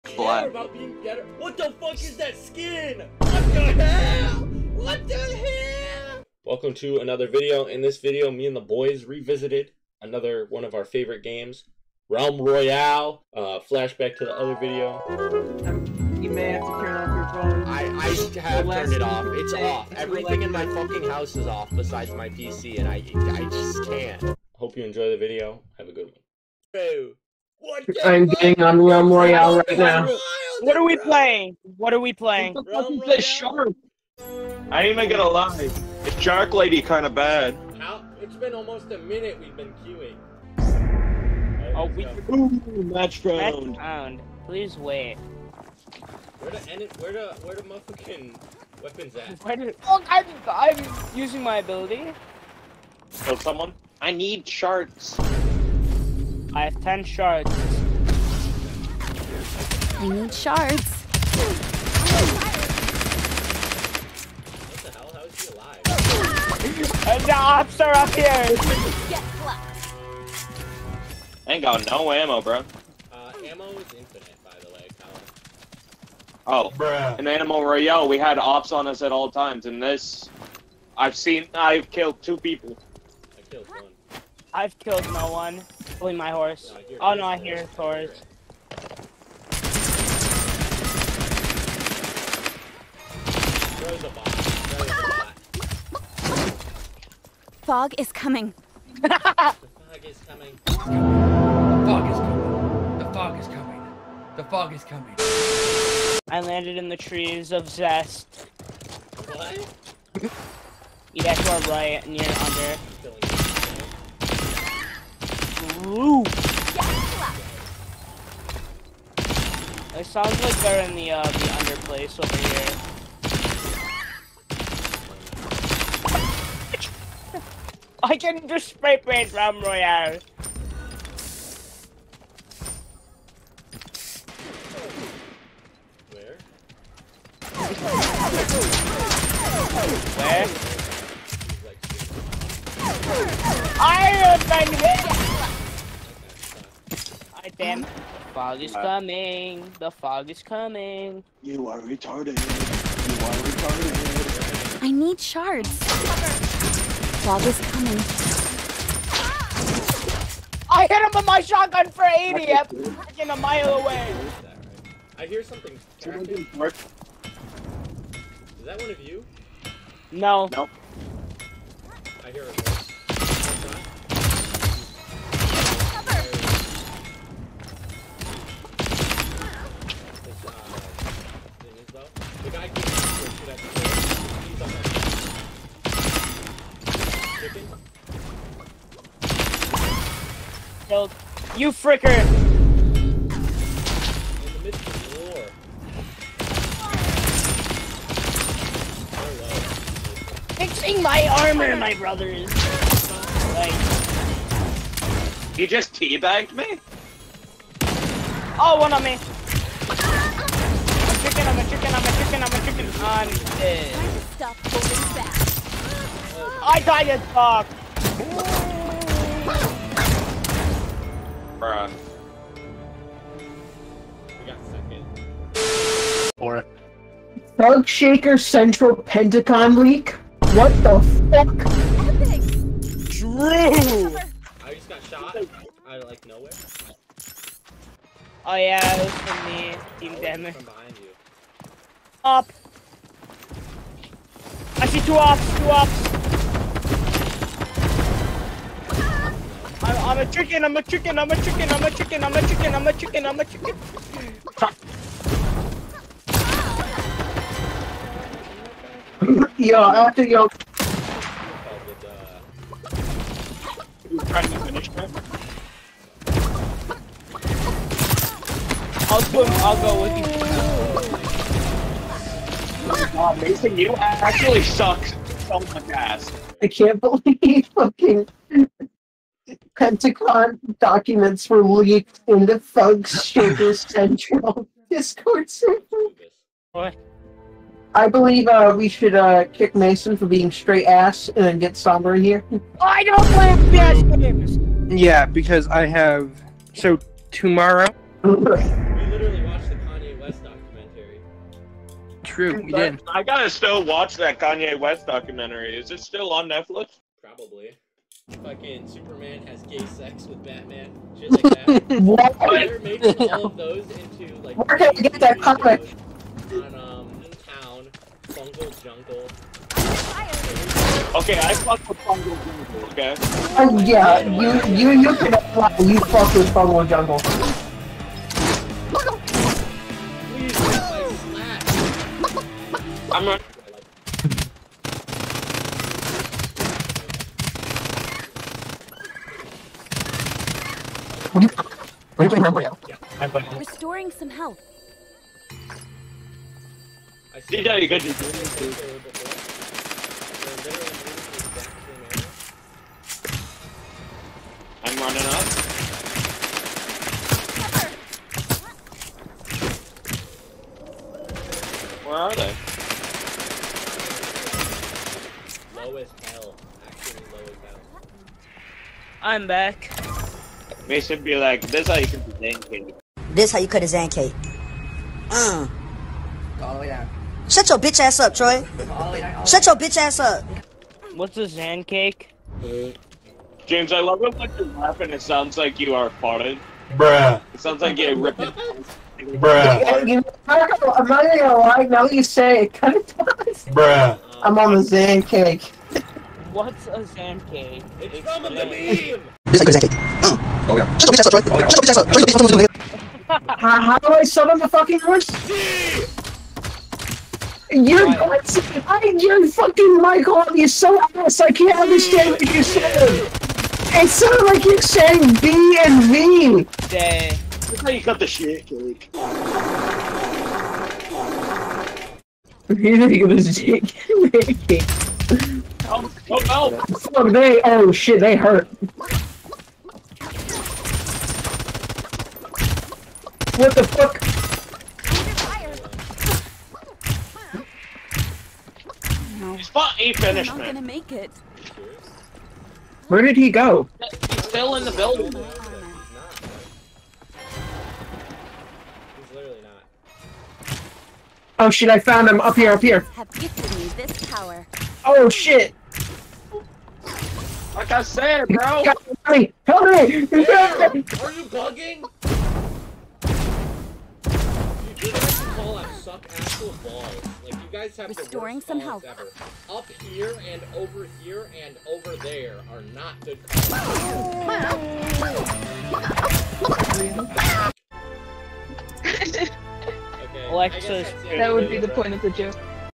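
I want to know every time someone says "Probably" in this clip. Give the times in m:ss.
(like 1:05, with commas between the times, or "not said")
1:26, 5:07.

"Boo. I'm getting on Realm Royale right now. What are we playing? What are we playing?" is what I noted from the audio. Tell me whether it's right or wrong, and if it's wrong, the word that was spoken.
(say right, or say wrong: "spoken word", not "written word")
right.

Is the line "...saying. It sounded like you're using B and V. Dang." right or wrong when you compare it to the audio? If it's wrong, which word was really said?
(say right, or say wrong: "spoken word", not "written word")
wrong: "saying", not "using".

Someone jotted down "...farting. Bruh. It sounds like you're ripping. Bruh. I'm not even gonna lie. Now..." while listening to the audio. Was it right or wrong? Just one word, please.
right.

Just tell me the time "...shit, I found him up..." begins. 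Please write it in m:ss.
7:31.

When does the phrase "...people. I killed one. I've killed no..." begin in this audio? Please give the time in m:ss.
1:22.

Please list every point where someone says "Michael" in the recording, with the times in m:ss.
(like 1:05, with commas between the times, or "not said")
6:49.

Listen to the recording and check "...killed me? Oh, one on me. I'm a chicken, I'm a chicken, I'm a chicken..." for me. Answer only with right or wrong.
wrong.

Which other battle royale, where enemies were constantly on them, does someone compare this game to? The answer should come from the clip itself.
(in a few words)
Animal Royale.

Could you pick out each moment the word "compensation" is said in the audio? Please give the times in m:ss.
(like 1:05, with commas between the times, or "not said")
not said.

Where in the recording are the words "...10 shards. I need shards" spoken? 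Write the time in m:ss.
0:56.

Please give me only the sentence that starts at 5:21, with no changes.
Okay, I fuck with Fungal Jungle.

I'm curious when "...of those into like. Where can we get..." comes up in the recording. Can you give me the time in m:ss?
5:13.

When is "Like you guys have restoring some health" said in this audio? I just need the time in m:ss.
7:47.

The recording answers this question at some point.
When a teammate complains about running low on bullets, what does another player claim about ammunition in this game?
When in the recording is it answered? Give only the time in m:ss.
1:13.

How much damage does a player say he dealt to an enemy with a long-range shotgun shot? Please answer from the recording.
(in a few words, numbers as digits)
80.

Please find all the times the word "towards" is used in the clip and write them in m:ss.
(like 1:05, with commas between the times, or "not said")
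not said.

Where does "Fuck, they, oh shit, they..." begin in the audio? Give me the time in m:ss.
7:06.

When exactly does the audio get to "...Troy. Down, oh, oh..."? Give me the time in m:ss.
6:18.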